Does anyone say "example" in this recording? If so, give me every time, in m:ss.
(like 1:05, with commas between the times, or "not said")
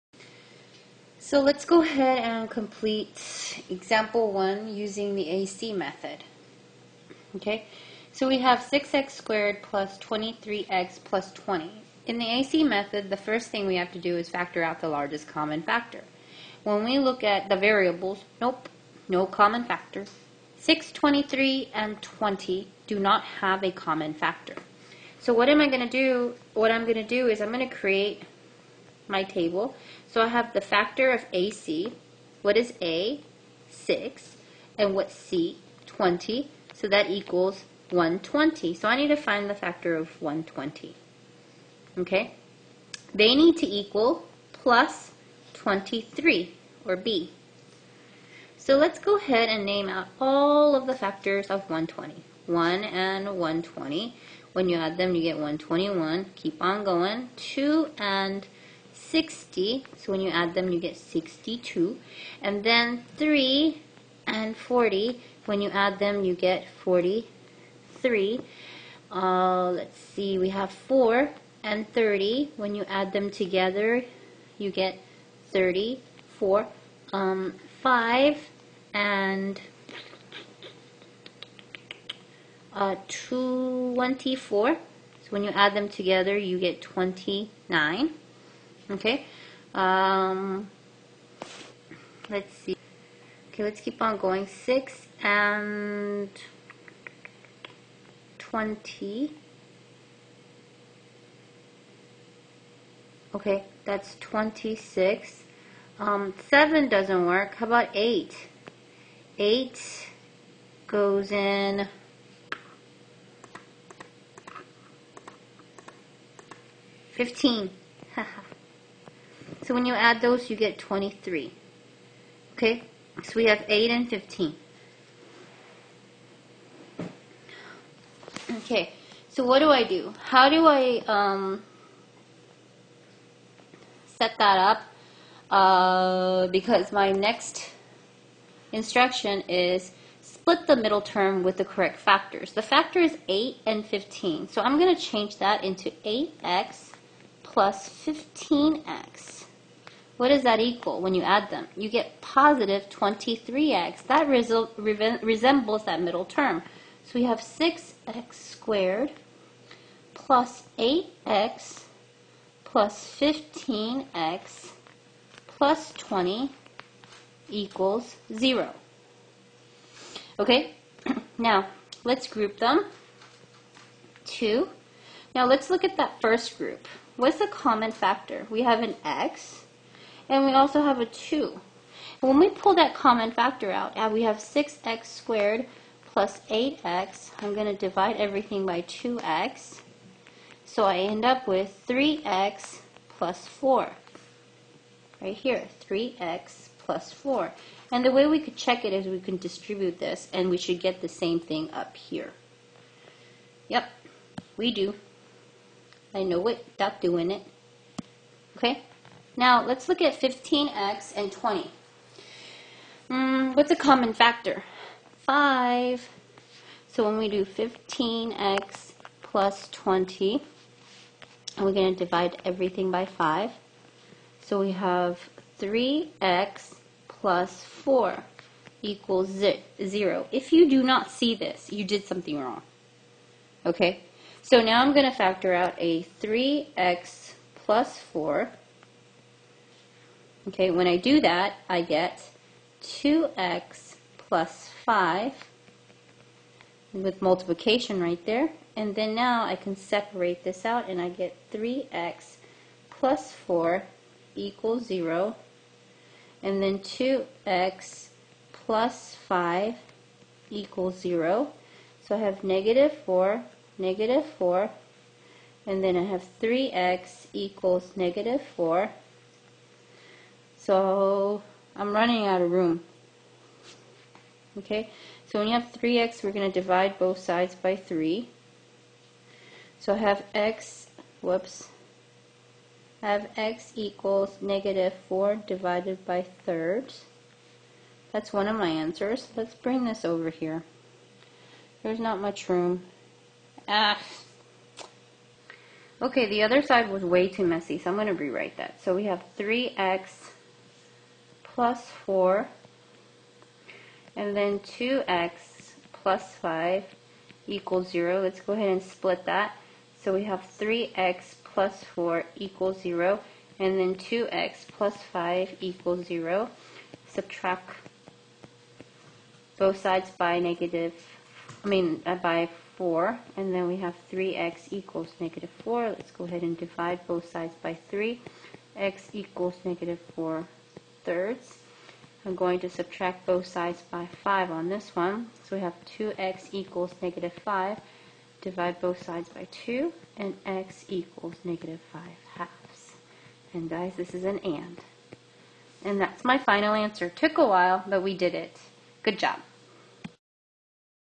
0:03.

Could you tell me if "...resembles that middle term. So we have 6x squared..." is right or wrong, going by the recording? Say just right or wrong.
right.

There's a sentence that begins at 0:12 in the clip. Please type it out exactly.
In the AC method, the first thing we have to do is factor out the largest common factor.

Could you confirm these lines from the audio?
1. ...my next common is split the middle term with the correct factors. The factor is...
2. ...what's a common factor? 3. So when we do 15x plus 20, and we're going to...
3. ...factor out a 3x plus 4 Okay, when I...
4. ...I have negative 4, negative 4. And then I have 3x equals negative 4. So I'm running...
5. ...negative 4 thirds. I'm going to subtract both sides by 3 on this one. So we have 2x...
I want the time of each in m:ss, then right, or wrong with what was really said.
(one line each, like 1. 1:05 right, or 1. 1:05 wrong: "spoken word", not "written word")
1. 2:16 wrong: "instruction", not "common"
2. 3:33 wrong: "5", not "3"
3. 3:55 right
4. 4:22 right
5. 5:29 wrong: "5", not "3".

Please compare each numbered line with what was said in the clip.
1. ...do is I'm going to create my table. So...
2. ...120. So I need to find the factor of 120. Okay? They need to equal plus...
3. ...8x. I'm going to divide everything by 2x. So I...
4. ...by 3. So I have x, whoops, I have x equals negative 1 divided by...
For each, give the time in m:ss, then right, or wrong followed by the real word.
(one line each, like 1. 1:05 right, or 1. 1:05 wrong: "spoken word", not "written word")
1. 0:27 right
2. 0:37 right
3. 3:06 right
4. 4:37 wrong: "4", not "1".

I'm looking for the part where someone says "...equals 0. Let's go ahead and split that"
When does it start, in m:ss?
5:07.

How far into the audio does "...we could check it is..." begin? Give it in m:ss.
3:18.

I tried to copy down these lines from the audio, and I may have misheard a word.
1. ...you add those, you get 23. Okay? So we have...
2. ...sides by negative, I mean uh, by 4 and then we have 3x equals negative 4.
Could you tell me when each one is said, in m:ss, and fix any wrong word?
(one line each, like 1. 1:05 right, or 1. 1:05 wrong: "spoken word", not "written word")
1. 1:59 right
2. 5:19 right.